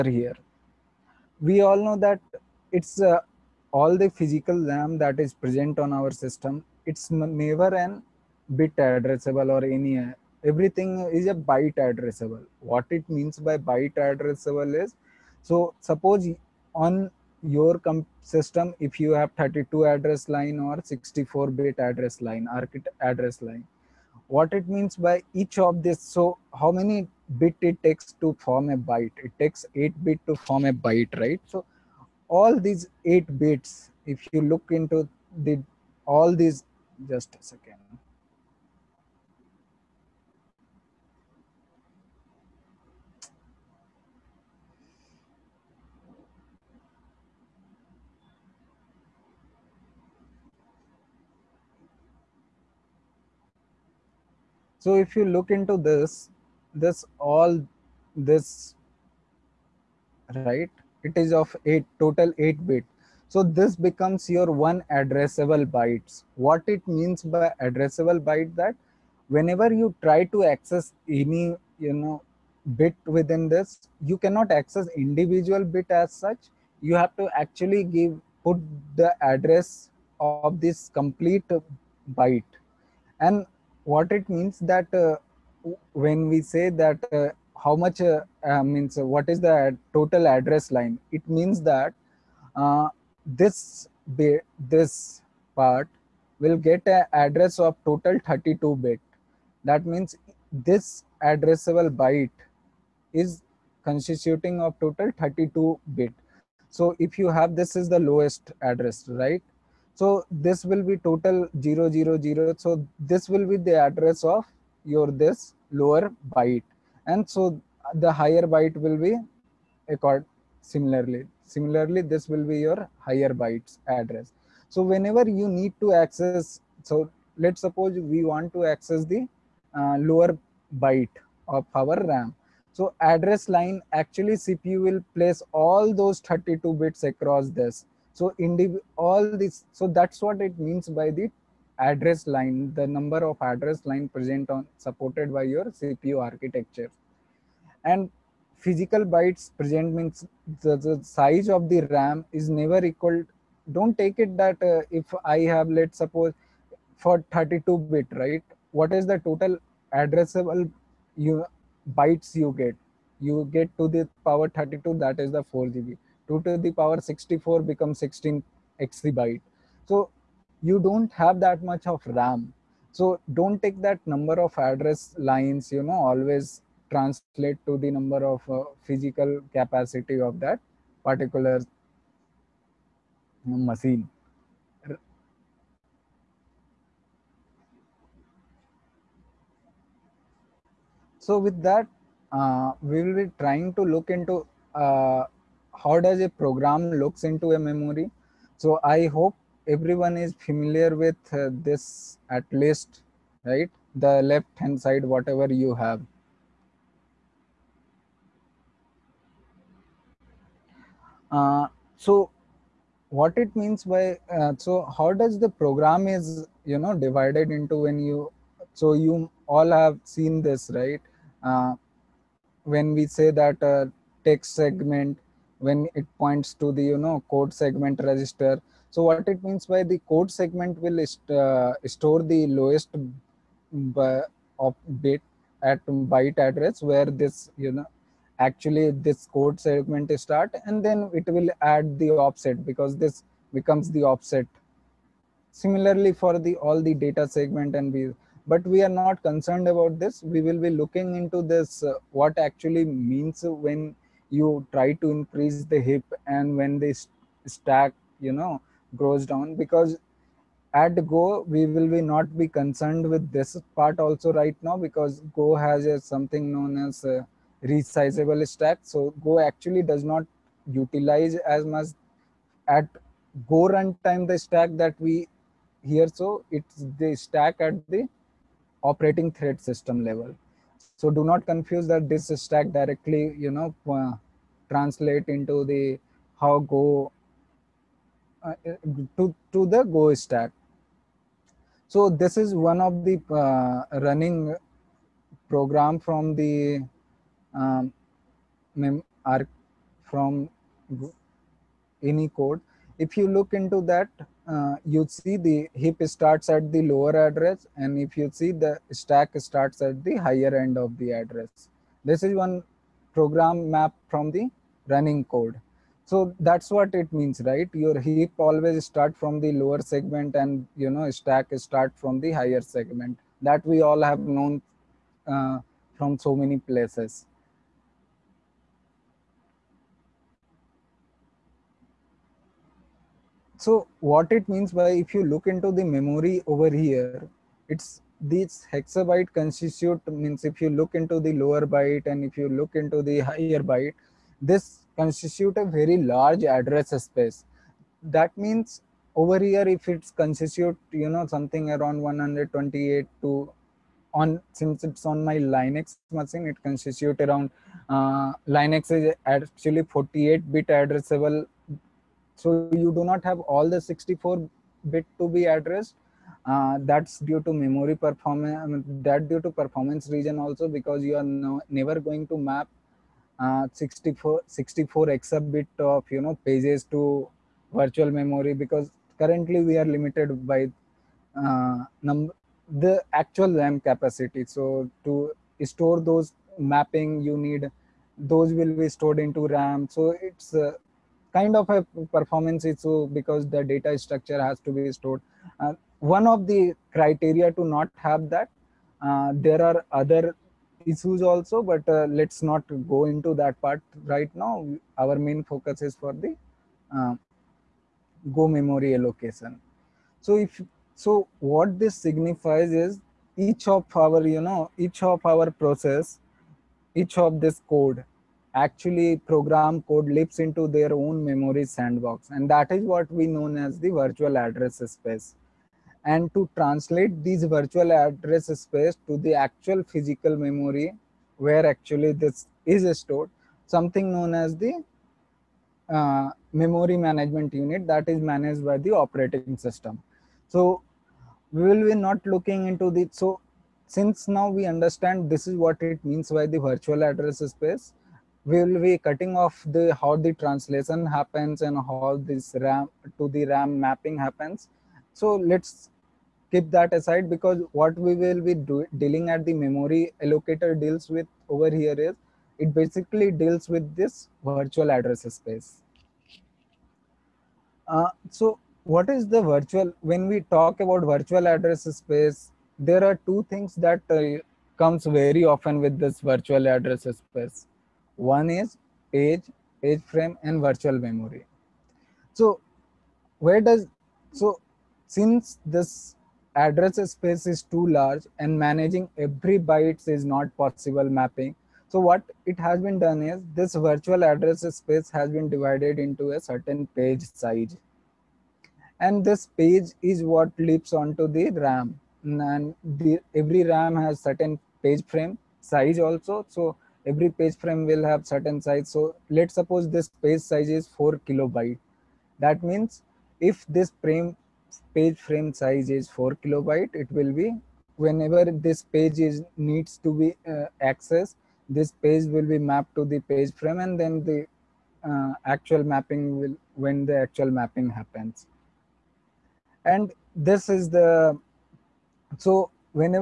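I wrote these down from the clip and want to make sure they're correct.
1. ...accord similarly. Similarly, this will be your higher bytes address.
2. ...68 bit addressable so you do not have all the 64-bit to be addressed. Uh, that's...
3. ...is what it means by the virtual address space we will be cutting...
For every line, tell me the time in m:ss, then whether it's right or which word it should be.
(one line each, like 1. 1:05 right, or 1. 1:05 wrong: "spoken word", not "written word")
1. 1:59 right
2. 5:59 wrong: "48", not "68"
3. 7:25 right.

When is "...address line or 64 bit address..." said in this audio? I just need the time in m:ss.
0:19.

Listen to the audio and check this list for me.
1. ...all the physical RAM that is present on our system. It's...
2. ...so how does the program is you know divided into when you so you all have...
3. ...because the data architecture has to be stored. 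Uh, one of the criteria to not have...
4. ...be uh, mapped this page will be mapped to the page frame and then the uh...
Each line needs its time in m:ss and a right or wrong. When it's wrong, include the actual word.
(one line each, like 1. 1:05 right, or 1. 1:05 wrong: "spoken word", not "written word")
1. 0:03 right
2. 3:34 right
3. 6:33 wrong: "structure", not "architecture"
4. 8:40 wrong: "accessed", not "mapped".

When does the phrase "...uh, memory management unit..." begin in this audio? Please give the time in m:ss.
7:15.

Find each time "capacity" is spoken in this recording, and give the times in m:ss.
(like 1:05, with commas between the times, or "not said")
2:59, 6:23.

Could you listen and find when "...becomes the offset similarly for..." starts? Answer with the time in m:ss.
4:03.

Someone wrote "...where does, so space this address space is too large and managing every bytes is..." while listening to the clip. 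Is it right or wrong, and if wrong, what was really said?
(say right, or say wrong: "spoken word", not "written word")
wrong: "since", not "space".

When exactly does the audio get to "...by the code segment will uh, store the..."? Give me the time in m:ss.
3:49.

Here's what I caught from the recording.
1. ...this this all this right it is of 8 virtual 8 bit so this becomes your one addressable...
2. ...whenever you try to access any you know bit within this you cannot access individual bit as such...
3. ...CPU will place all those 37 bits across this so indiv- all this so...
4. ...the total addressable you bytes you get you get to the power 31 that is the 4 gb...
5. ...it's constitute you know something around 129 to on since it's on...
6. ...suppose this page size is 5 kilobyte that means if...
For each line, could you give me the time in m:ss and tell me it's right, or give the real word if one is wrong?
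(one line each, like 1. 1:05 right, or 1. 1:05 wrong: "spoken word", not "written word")
1. 0:55 wrong: "total", not "virtual"
2. 1:09 right
3. 2:14 wrong: "32", not "37"
4. 2:39 wrong: "32", not "31"
5. 5:49 wrong: "128", not "129"
6. 8:29 wrong: "4", not "5".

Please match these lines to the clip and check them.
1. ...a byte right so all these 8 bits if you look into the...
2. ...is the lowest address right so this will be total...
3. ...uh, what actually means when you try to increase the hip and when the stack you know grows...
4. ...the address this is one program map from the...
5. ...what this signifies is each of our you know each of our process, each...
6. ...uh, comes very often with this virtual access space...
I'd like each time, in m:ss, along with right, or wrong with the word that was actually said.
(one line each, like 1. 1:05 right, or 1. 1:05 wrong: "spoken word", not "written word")
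1. 0:30 right
2. 1:47 right
3. 4:11 right
4. 5:10 right
5. 6:51 right
6. 7:54 wrong: "address", not "access".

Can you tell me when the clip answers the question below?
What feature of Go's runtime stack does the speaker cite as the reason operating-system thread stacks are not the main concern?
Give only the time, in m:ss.
4:27.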